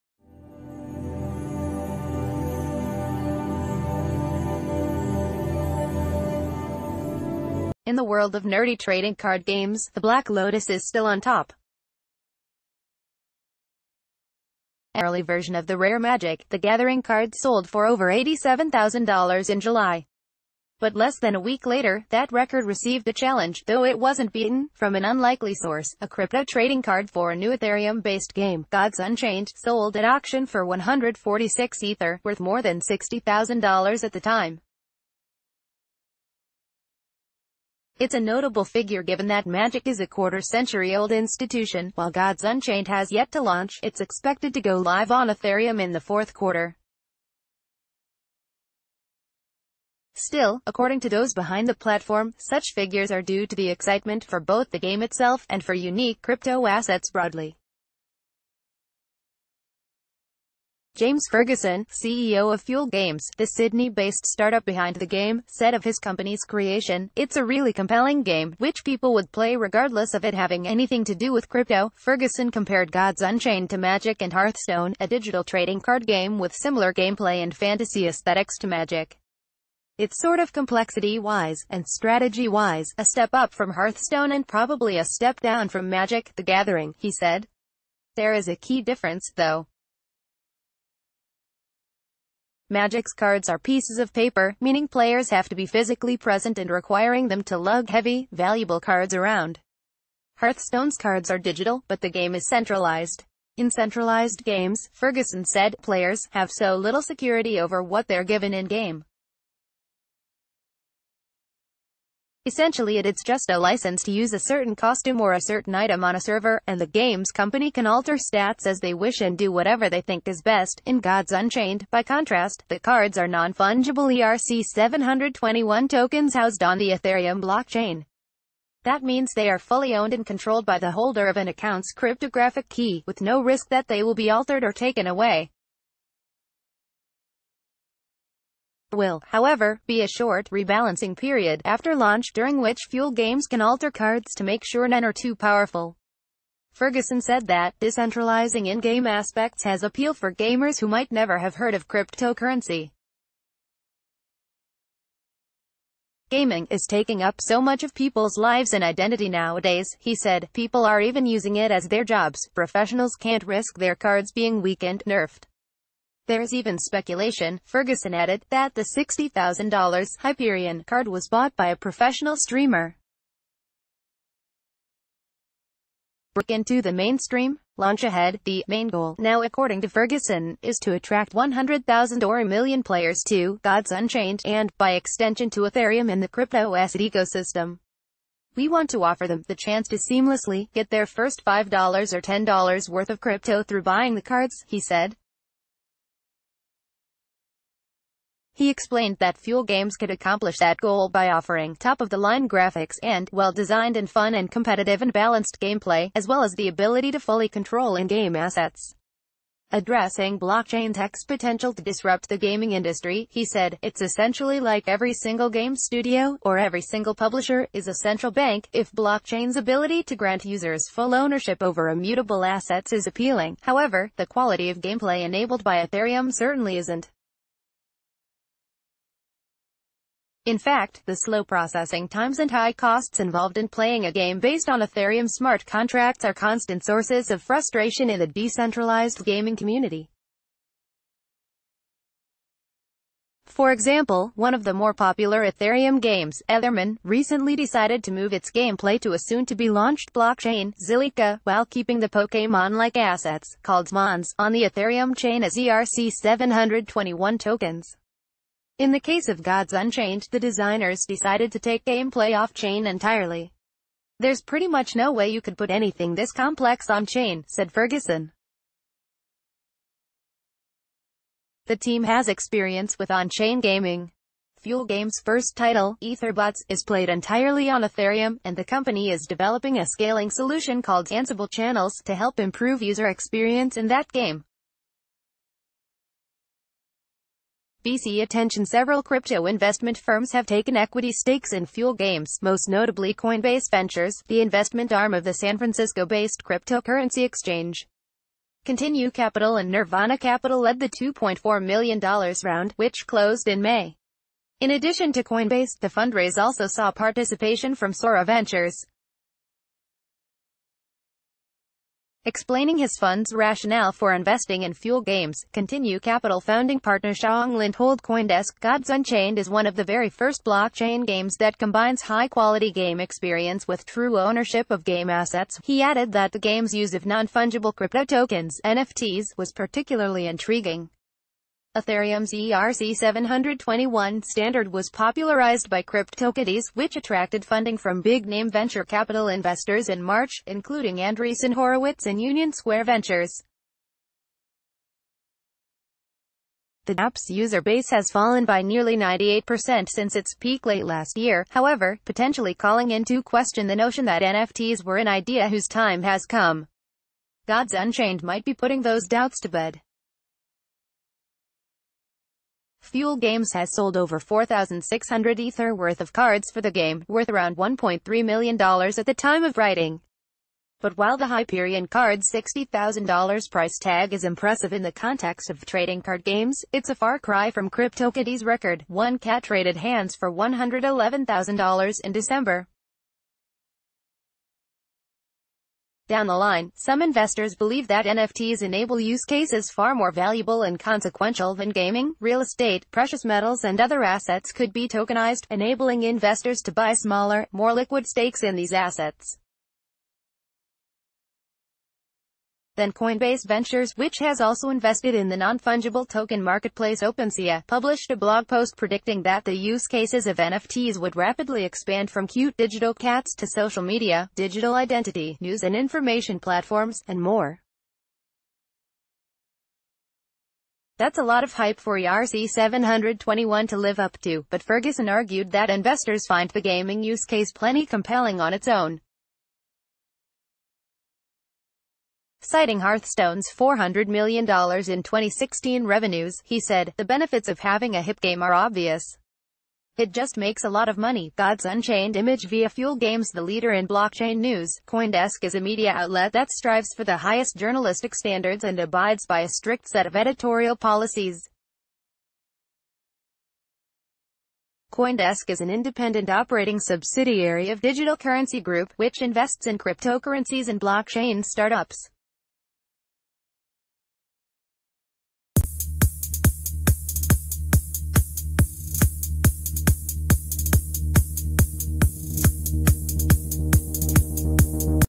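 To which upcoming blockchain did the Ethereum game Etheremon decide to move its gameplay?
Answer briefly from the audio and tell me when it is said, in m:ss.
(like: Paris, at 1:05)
Zilliqa, at 4:10.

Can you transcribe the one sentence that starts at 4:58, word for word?
Continue Capital and Nirvana Capital led the $2.4 million round, which closed in May.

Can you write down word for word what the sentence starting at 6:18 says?
One cat traded hands for $111,000 in December.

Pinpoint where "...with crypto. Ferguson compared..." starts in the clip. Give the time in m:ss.
1:11.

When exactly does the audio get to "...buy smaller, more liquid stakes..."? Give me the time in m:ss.
6:36.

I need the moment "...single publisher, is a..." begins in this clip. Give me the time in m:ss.
3:36.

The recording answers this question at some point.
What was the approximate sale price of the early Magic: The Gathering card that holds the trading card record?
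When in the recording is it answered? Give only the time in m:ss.
0:18.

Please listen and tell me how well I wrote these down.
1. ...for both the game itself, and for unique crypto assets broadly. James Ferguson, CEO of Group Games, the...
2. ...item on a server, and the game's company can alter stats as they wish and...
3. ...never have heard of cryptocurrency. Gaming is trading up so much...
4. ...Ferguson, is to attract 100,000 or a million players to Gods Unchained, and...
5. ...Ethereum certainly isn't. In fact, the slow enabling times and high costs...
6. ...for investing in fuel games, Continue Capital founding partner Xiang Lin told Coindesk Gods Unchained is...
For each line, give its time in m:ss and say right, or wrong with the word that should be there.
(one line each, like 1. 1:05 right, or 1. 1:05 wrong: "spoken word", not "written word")
1. 0:54 wrong: "Fuel", not "Group"
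2. 1:55 right
3. 2:31 wrong: "taking", not "trading"
4. 2:59 right
5. 3:45 wrong: "processing", not "enabling"
6. 5:13 right.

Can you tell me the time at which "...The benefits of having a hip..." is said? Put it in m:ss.
7:16.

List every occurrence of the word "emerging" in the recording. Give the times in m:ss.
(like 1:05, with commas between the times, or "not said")
not said.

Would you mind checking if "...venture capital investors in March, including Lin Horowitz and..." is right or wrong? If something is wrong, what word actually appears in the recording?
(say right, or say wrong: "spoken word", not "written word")
wrong: "Andreessen", not "Lin".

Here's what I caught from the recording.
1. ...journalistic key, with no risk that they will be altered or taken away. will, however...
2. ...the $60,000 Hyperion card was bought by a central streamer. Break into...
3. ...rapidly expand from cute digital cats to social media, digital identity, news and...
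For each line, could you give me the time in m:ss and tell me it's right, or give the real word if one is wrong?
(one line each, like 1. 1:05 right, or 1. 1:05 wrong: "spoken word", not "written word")
1. 2:11 wrong: "cryptographic", not "journalistic"
2. 2:48 wrong: "professional", not "central"
3. 6:51 right.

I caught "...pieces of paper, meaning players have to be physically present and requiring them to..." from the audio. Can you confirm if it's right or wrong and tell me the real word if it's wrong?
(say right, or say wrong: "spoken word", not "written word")
right.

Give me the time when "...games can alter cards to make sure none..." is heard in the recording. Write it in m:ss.
2:23.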